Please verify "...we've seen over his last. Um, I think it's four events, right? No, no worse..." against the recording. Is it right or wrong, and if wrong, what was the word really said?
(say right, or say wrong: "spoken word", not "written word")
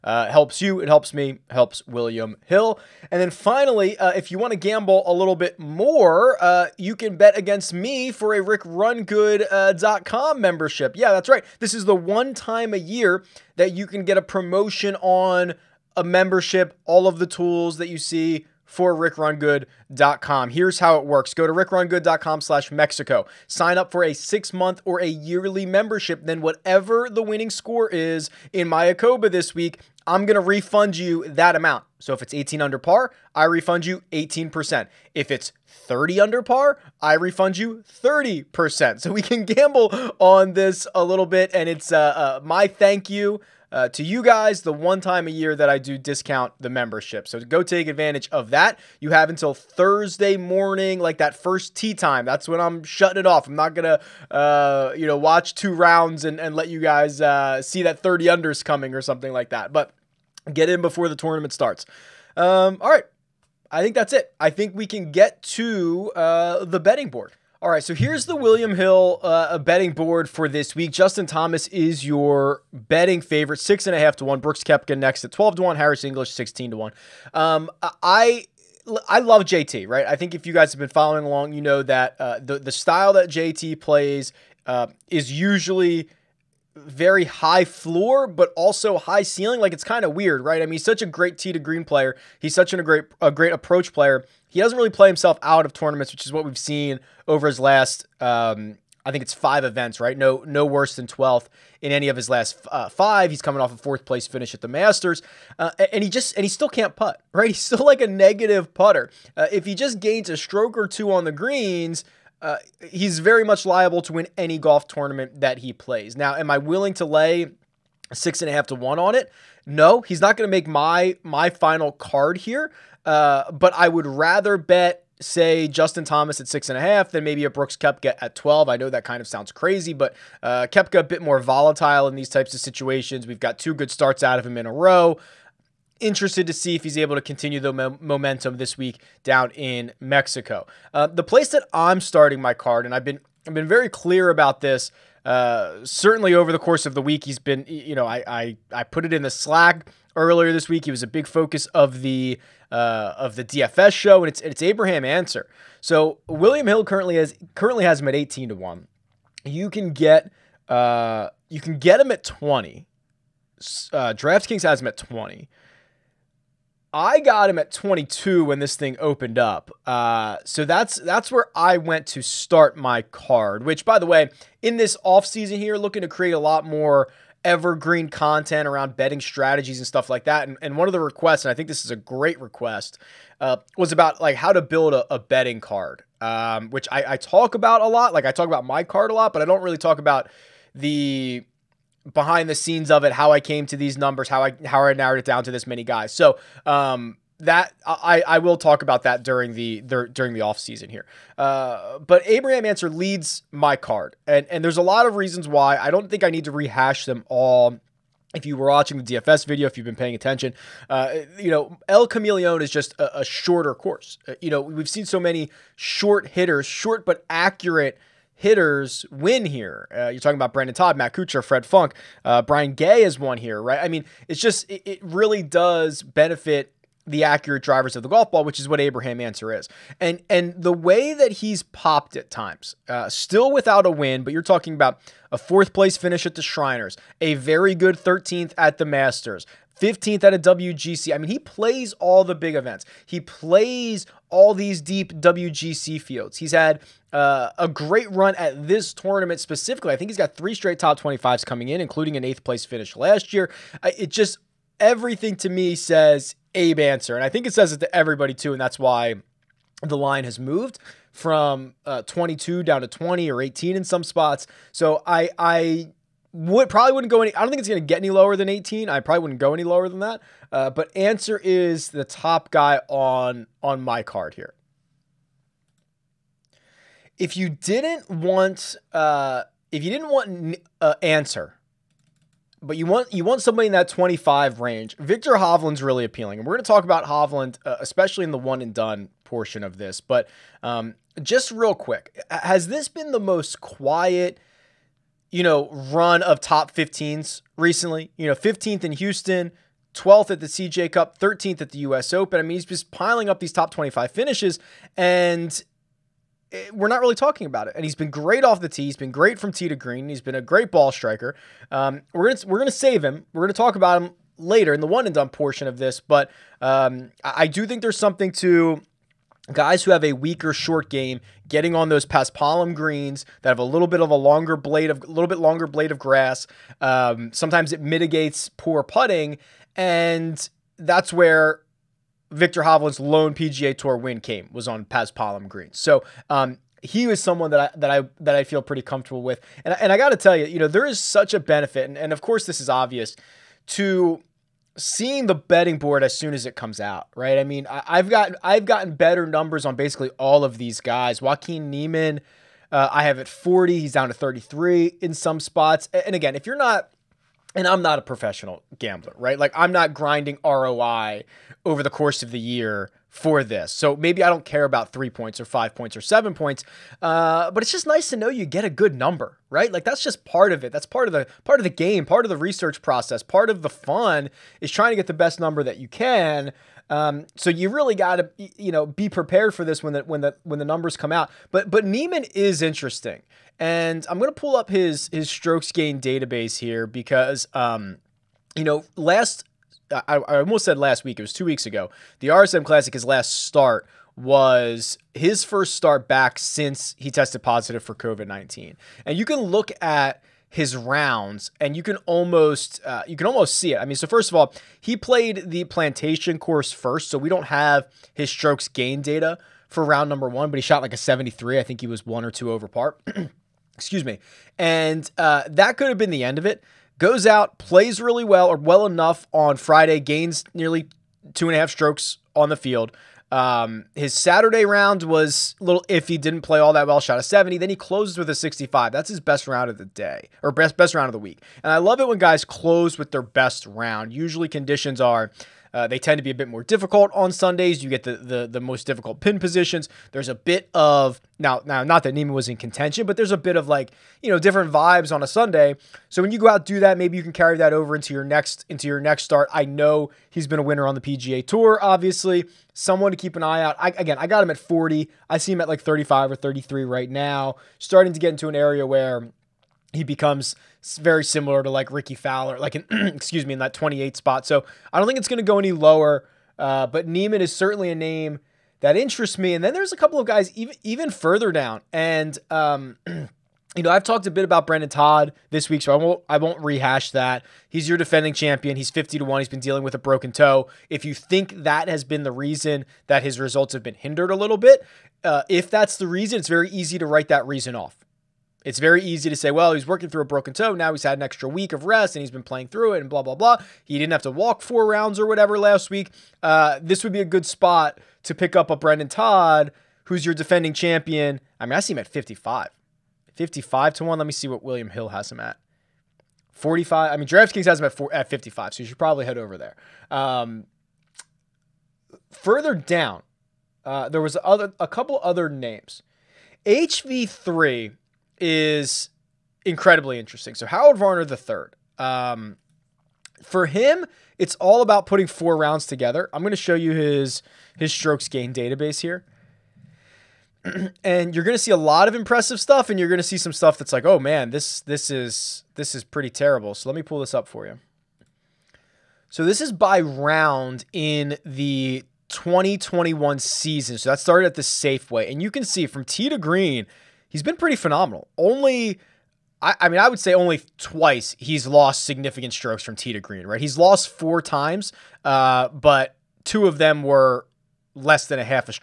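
wrong: "five", not "four".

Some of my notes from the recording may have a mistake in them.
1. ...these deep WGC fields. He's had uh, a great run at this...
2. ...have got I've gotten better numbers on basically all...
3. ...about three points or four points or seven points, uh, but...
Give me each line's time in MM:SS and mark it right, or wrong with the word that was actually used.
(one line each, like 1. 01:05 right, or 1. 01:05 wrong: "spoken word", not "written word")
1. 04:04 right
2. 05:47 right
3. 06:04 wrong: "five", not "four".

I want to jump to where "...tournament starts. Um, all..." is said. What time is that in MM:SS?
01:01.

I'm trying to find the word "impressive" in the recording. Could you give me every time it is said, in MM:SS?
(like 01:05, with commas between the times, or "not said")
08:52.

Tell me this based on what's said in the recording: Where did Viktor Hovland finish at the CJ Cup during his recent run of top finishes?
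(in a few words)
12th.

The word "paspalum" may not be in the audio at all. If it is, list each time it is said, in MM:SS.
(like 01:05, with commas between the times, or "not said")
05:22, 05:34.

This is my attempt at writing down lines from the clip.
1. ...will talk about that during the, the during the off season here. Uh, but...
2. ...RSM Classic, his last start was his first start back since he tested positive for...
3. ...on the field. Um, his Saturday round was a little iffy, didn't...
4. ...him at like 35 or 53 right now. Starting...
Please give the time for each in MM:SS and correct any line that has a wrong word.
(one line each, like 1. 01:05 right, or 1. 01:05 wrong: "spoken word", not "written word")
1. 03:18 right
2. 06:32 right
3. 07:02 right
4. 07:35 wrong: "33", not "53".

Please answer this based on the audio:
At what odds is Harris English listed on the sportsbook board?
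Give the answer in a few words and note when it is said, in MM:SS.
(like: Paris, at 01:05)
16 to 1, at 01:15.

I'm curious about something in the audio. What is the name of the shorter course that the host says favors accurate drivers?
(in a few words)
El Camaleon.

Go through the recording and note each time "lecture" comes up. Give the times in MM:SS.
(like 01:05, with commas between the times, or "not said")
not said.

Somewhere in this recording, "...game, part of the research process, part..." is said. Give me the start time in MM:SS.
06:11.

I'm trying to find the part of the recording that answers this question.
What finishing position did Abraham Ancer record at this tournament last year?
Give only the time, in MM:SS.
04:12.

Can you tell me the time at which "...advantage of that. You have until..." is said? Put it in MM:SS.
00:47.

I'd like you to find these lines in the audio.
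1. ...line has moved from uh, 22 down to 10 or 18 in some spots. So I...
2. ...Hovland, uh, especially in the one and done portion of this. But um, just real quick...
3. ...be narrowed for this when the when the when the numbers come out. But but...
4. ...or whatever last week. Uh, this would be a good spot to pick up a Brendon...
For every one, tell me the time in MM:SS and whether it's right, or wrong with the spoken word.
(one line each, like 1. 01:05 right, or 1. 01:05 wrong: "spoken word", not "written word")
1. 04:19 wrong: "20", not "10"
2. 04:47 right
3. 06:18 wrong: "prepared", not "narrowed"
4. 08:15 right.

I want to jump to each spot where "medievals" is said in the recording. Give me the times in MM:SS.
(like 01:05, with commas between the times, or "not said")
not said.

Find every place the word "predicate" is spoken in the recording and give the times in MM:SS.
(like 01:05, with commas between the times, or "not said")
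not said.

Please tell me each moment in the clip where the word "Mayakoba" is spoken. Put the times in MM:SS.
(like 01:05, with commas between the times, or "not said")
00:28.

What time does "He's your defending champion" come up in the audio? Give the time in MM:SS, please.
07:57.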